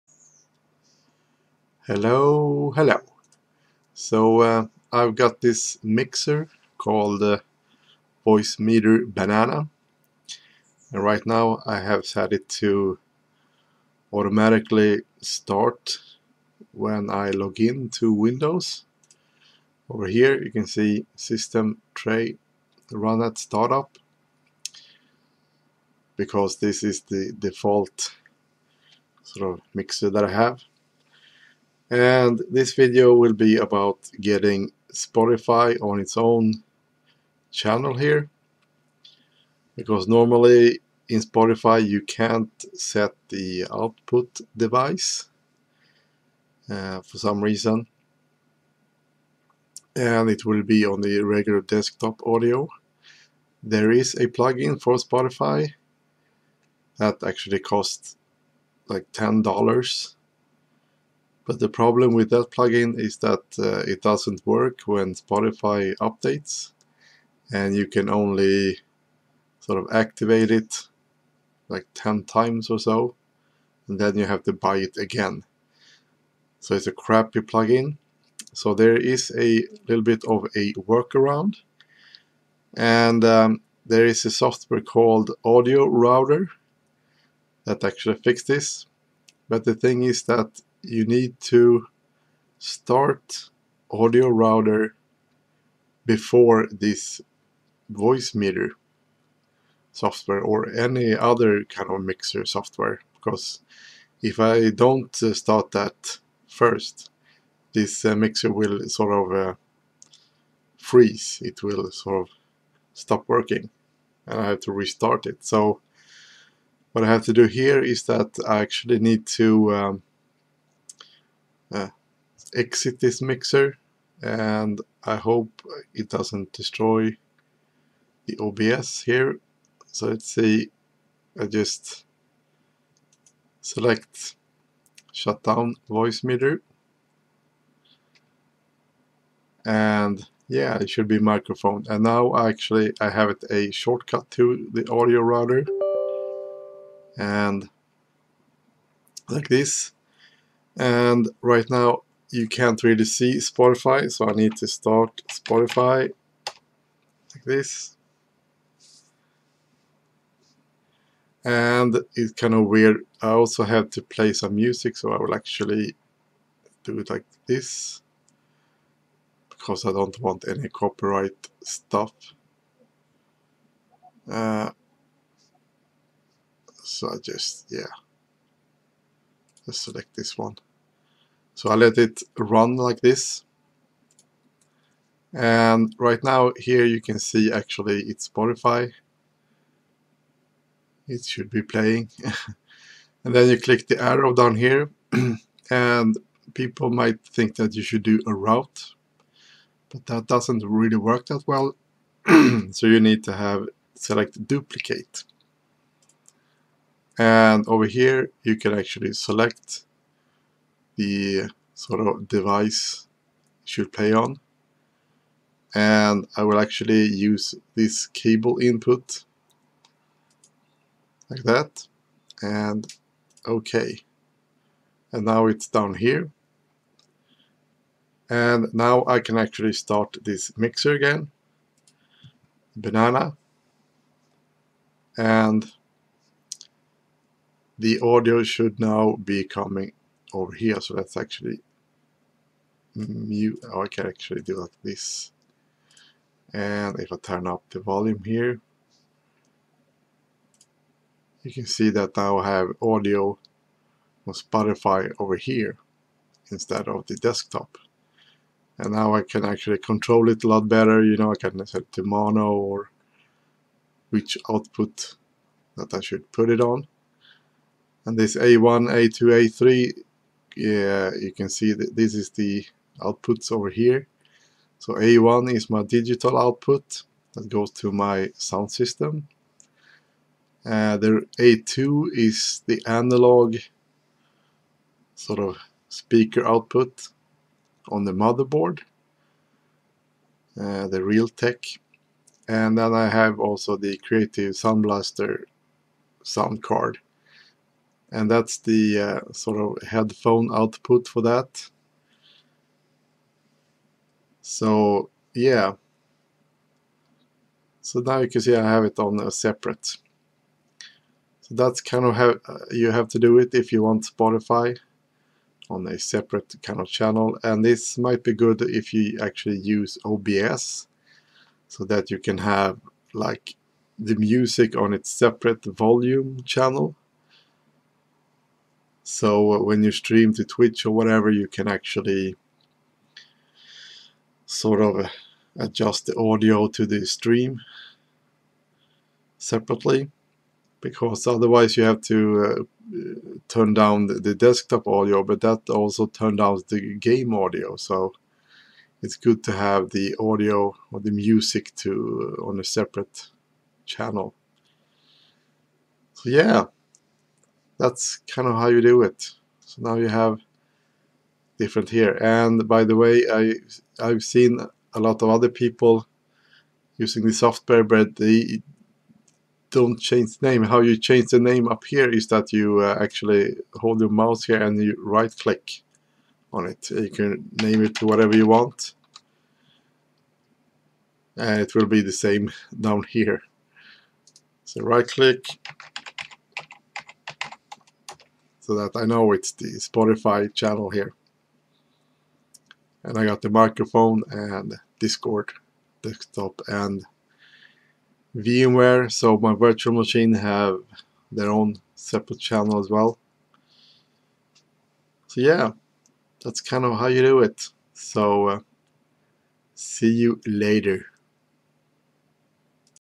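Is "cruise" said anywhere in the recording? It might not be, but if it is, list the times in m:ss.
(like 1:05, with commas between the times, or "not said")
not said.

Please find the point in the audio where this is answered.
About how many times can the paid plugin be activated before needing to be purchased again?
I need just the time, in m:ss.
1:11.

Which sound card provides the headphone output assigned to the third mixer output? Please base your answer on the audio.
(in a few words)
Creative Sound Blaster.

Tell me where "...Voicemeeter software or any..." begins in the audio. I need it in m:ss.
1:37.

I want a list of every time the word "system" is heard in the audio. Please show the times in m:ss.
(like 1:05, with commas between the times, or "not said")
0:21, 4:38.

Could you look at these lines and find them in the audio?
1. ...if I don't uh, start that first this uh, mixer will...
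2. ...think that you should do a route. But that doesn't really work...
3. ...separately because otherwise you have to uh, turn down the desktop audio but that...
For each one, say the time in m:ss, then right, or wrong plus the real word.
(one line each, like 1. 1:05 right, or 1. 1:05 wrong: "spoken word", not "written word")
1. 1:44 right
2. 3:17 right
3. 5:39 right.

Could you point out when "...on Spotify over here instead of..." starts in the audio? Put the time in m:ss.
4:14.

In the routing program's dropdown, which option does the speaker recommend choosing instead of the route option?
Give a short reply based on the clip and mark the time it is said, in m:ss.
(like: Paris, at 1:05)
duplicate, at 3:24.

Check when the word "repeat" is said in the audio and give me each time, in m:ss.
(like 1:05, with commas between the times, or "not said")
not said.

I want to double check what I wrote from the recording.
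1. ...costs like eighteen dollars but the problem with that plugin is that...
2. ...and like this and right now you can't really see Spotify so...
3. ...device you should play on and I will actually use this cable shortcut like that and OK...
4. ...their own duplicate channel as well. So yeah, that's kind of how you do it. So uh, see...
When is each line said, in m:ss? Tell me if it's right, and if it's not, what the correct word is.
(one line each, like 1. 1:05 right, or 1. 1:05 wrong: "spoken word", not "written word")
1. 0:57 wrong: "ten", not "eighteen"
2. 2:27 right
3. 3:32 wrong: "input", not "shortcut"
4. 6:41 wrong: "separate", not "duplicate".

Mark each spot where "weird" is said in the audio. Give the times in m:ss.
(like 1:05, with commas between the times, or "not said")
2:42.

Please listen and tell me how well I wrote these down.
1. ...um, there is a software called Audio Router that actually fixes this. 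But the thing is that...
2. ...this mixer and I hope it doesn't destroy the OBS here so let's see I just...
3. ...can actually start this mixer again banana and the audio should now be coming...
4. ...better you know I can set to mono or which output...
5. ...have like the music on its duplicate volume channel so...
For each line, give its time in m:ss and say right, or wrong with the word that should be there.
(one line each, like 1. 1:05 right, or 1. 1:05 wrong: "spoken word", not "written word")
1. 1:23 right
2. 2:02 right
3. 3:49 right
4. 4:20 right
5. 5:22 wrong: "separate", not "duplicate".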